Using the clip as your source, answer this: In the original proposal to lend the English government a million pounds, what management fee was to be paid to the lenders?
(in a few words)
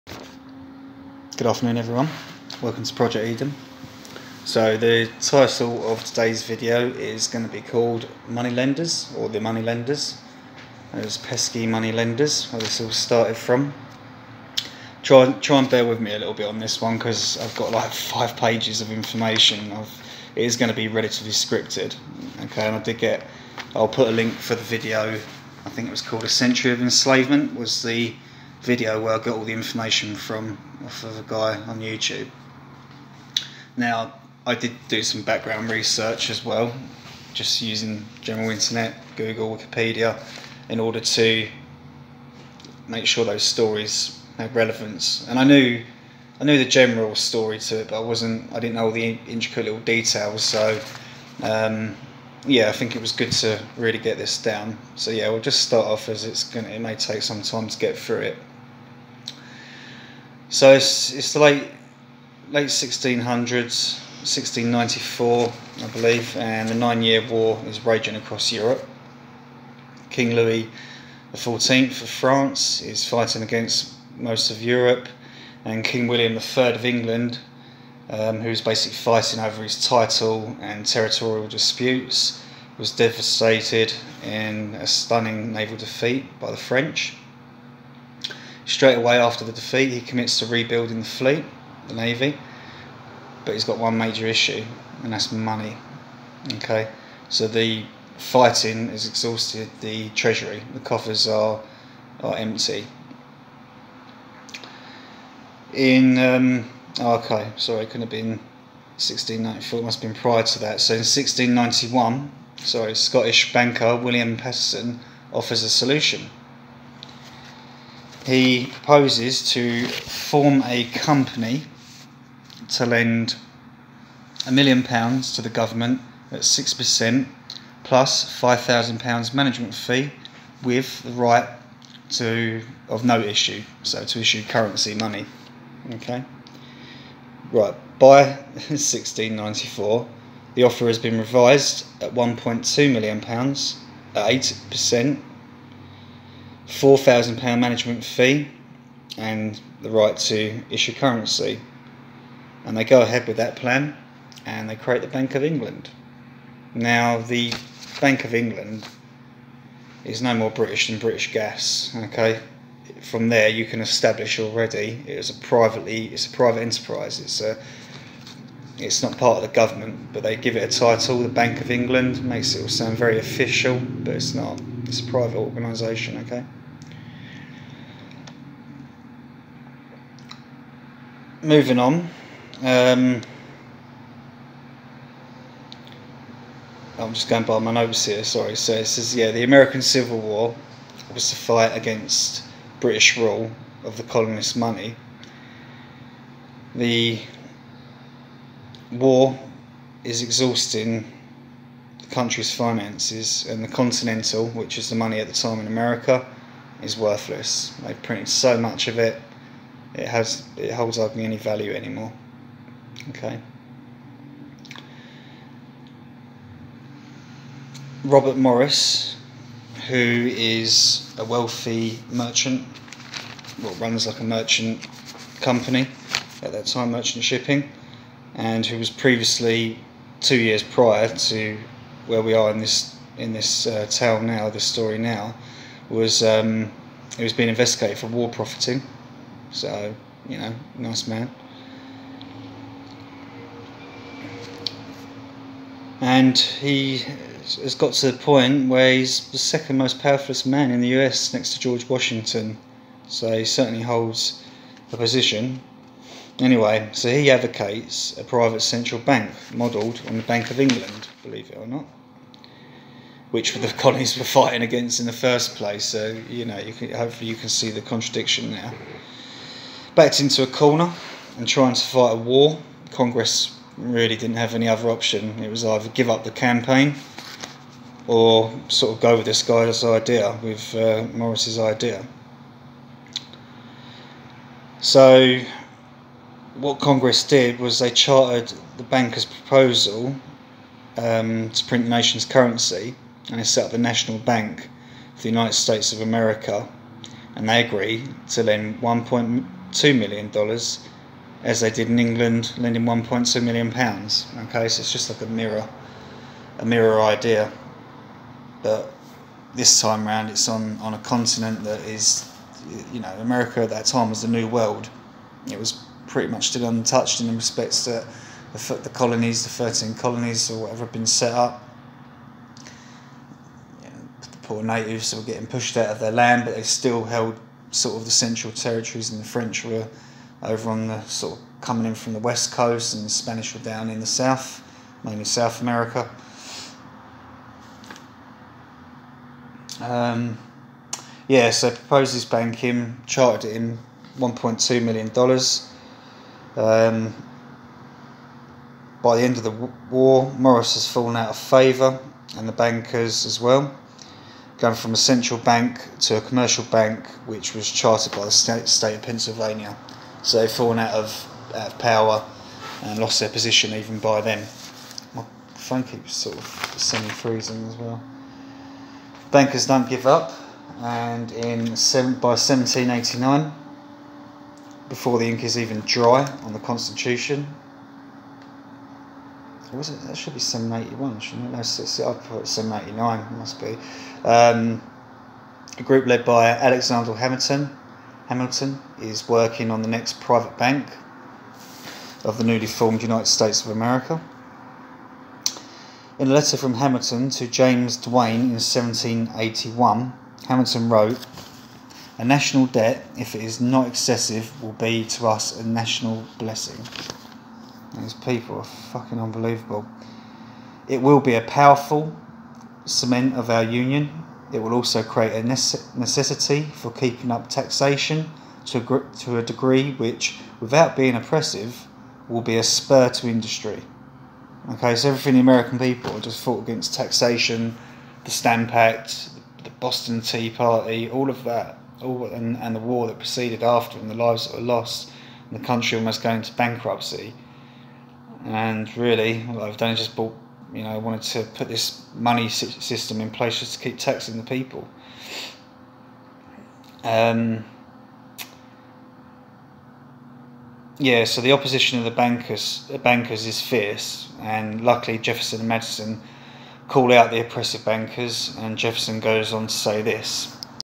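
£5,000.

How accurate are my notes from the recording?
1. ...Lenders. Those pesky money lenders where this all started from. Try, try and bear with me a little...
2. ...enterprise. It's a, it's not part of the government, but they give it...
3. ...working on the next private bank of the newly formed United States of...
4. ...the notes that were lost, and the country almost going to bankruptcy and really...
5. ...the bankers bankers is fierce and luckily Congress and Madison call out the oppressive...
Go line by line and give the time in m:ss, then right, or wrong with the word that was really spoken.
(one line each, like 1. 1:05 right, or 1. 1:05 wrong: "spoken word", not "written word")
1. 0:09 right
2. 2:46 right
3. 6:29 right
4. 7:14 wrong: "lives", not "notes"
5. 7:32 wrong: "Jefferson", not "Congress".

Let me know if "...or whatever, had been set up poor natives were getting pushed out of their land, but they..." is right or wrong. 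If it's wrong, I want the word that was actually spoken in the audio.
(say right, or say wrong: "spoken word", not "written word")
right.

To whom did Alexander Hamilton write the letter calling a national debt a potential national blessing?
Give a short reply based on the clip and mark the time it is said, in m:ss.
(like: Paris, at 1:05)
James Duane, at 6:37.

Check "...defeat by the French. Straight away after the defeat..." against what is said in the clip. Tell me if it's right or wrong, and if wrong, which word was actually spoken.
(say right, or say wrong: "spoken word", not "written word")
right.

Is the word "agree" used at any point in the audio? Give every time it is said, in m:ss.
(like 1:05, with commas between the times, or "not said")
4:57.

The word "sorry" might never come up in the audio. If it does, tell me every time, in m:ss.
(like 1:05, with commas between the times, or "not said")
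1:47, 1:52, 3:08.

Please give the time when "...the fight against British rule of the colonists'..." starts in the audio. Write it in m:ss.
3:11.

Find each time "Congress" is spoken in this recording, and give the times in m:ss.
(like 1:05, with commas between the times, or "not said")
4:32, 4:46.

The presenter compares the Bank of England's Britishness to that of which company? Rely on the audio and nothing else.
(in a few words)
British Gas.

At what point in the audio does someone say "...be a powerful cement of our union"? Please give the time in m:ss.
6:51.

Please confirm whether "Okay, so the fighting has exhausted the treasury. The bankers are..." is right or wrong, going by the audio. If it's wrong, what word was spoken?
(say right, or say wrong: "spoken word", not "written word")
wrong: "coffers", not "bankers".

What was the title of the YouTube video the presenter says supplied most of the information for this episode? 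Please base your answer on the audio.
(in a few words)
A Century of Enslavement.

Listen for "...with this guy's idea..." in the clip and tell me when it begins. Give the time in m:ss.
4:39.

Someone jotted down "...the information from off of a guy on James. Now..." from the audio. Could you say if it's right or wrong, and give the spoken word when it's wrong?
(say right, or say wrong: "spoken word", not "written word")
wrong: "YouTube", not "James".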